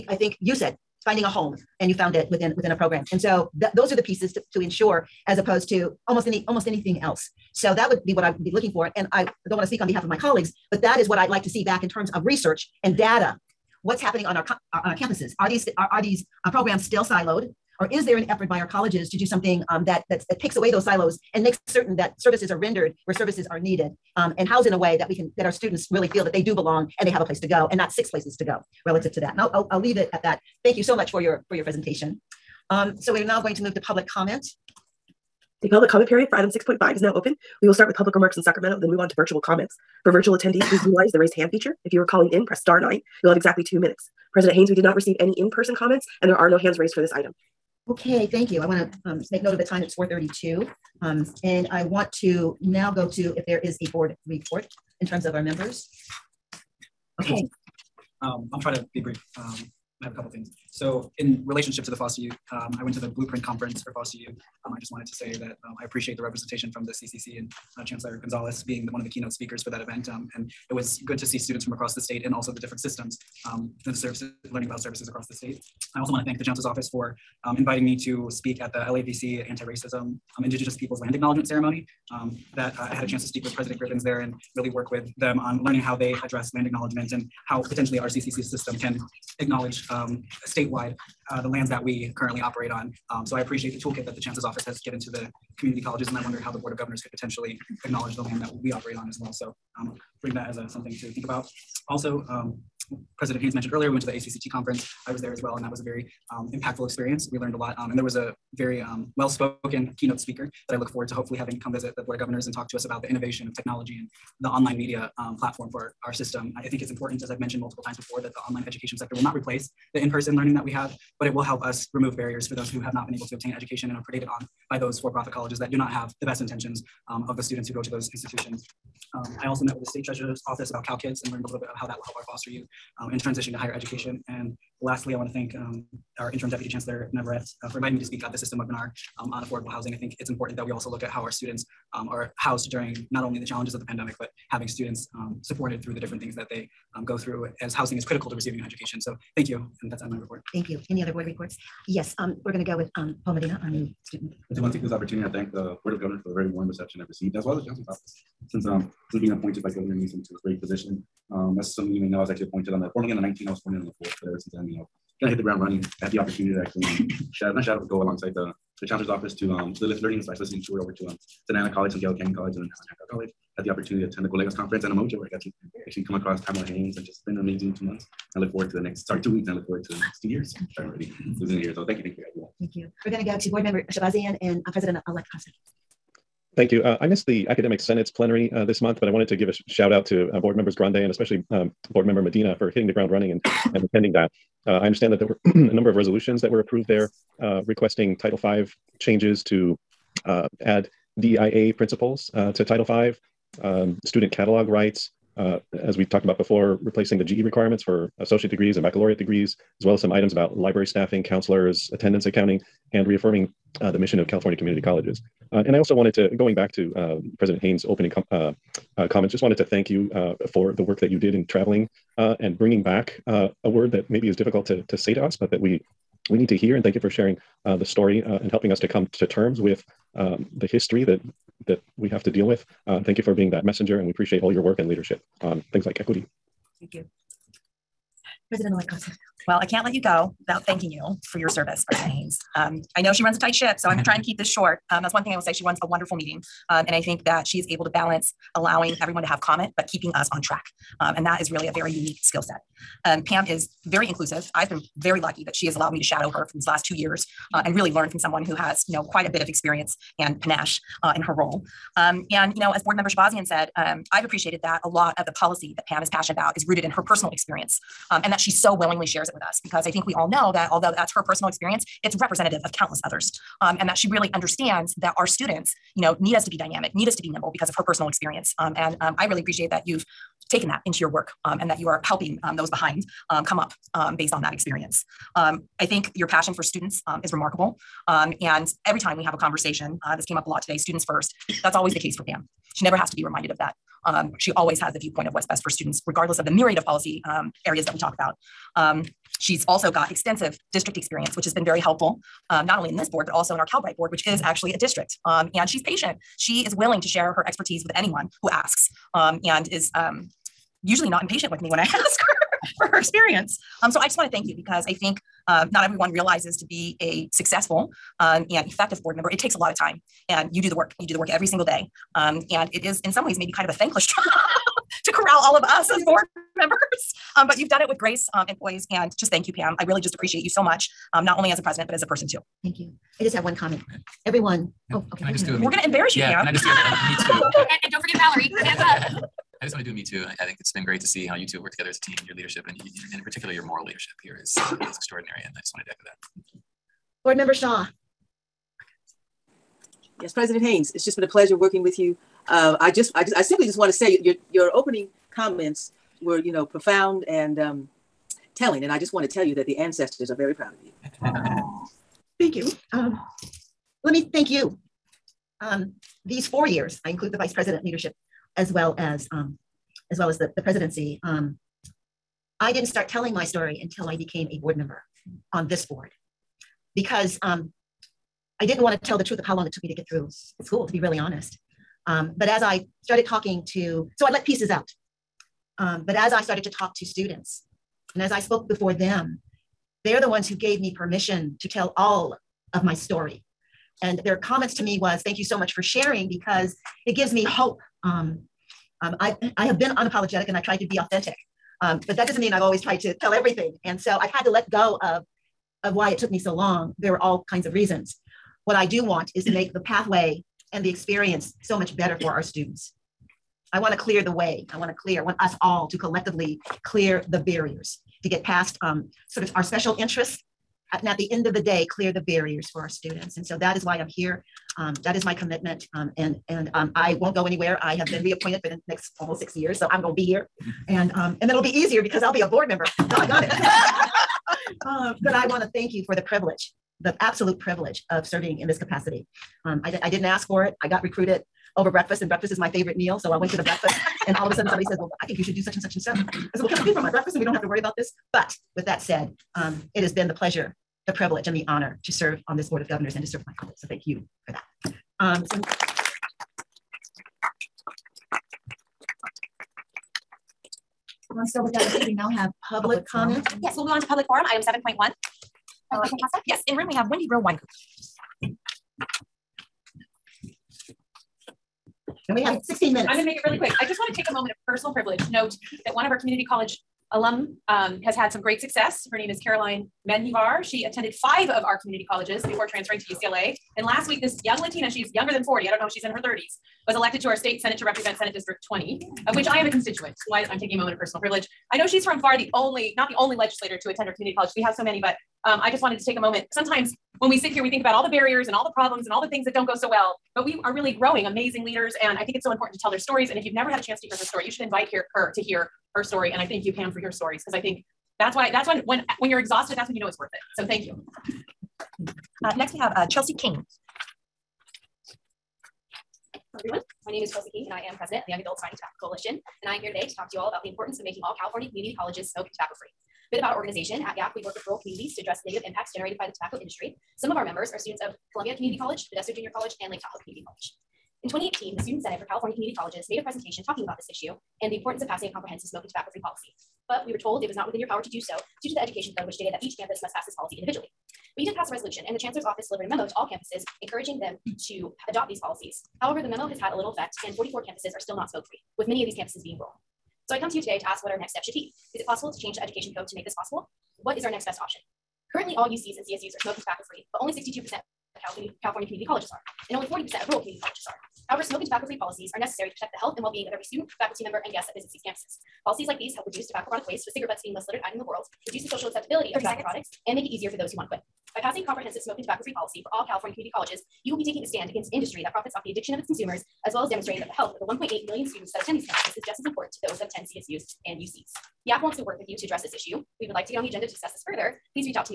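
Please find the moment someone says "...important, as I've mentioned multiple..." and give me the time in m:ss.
1:56.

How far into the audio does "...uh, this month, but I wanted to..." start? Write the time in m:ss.
3:08.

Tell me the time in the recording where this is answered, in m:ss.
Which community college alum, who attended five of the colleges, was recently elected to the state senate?
7:59.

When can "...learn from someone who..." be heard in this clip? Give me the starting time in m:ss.
4:17.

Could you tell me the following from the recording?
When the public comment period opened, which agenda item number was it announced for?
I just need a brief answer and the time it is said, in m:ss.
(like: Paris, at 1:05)
6.5, at 0:36.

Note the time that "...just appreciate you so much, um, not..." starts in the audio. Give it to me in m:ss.
5:29.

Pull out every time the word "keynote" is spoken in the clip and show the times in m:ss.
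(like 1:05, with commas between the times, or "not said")
1:09, 1:49.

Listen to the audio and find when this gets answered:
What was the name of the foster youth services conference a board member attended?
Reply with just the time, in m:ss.
1:03.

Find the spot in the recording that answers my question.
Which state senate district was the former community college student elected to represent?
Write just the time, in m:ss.
8:08.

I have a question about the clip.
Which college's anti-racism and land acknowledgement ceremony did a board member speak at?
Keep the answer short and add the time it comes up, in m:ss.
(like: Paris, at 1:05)
LAVC, at 1:18.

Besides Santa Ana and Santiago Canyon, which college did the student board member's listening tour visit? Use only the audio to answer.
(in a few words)
Hancock College.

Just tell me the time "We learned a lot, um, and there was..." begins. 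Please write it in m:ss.
1:47.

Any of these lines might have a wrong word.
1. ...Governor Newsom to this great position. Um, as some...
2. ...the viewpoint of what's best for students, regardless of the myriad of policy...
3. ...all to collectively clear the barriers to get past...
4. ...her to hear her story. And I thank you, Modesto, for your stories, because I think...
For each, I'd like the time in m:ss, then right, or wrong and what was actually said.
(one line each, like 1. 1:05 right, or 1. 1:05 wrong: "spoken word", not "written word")
1. 2:39 right
2. 4:54 right
3. 6:55 right
4. 8:25 wrong: "Pam", not "Modesto".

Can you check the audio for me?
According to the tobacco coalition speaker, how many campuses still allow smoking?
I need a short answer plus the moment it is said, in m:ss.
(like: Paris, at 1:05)
44, at 9:07.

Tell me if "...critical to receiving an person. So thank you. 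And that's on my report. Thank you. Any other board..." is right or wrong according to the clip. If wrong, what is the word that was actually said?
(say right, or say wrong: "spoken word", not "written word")
wrong: "education", not "person".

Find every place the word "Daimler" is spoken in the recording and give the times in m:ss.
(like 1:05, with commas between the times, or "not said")
not said.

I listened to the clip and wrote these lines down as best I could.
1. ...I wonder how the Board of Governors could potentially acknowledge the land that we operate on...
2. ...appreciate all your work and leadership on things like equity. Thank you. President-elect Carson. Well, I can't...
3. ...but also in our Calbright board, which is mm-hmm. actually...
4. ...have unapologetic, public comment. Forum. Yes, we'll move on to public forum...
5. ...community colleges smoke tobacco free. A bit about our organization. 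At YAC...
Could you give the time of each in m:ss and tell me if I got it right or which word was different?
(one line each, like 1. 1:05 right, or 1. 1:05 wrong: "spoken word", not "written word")
1. 1:36 right
2. 3:54 right
3. 5:03 right
4. 7:42 wrong: "public", not "unapologetic"
5. 8:41 right.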